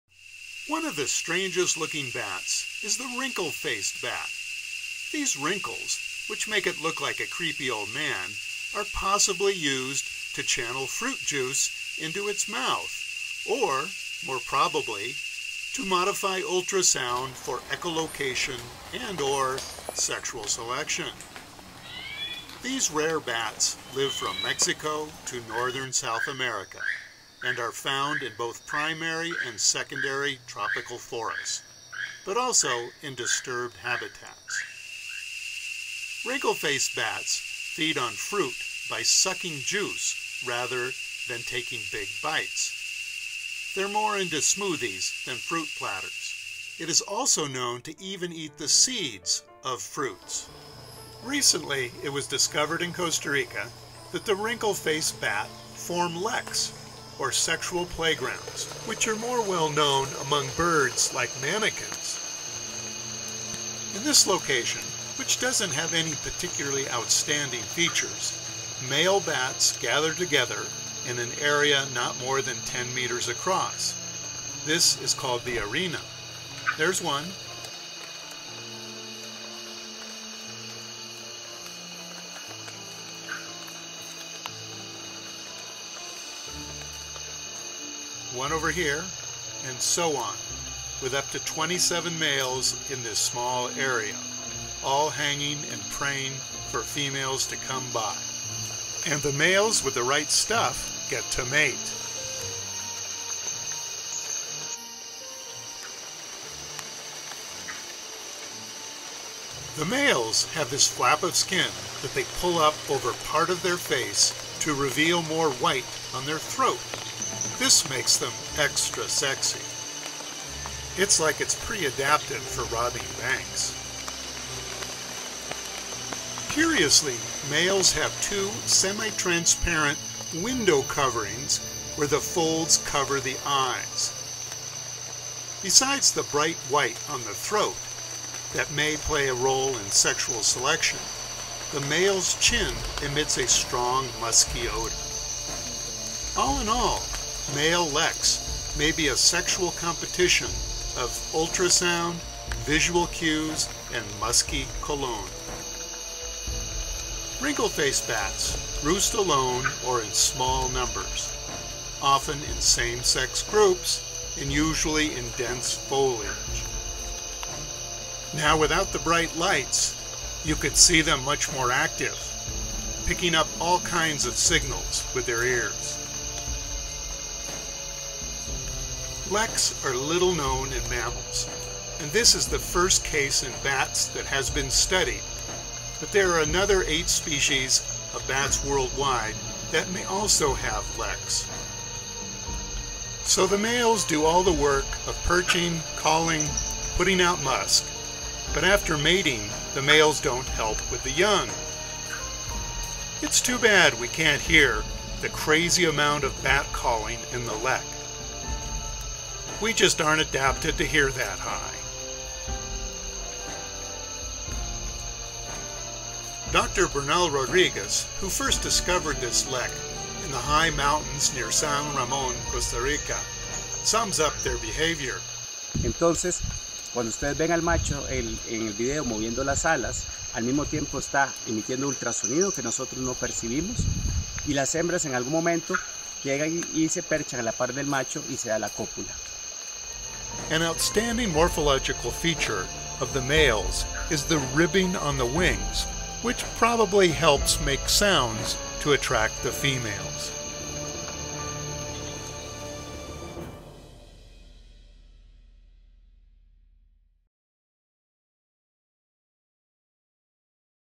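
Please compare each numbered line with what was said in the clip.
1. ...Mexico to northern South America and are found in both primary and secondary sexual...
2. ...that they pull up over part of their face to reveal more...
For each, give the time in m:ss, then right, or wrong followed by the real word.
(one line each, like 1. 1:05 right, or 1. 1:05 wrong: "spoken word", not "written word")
1. 0:24 wrong: "tropical", not "sexual"
2. 1:52 right.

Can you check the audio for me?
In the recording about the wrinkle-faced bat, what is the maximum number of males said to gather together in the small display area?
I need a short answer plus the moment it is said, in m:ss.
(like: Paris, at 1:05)
27, at 1:31.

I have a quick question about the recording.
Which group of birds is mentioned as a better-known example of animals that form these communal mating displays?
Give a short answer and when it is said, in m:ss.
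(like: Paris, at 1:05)
manakins, at 1:01.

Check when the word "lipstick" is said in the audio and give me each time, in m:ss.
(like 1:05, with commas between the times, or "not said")
not said.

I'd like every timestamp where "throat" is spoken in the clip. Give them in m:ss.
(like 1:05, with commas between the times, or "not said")
1:56, 2:17.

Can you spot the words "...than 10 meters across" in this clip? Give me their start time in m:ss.
1:12.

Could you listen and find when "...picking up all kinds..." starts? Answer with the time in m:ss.
2:53.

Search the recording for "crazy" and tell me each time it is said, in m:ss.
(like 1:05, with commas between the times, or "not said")
3:25.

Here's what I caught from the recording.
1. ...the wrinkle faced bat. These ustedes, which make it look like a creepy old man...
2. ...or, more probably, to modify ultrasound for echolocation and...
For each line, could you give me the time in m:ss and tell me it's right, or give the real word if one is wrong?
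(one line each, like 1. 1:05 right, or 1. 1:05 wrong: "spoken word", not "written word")
1. 0:02 wrong: "wrinkles", not "ustedes"
2. 0:13 right.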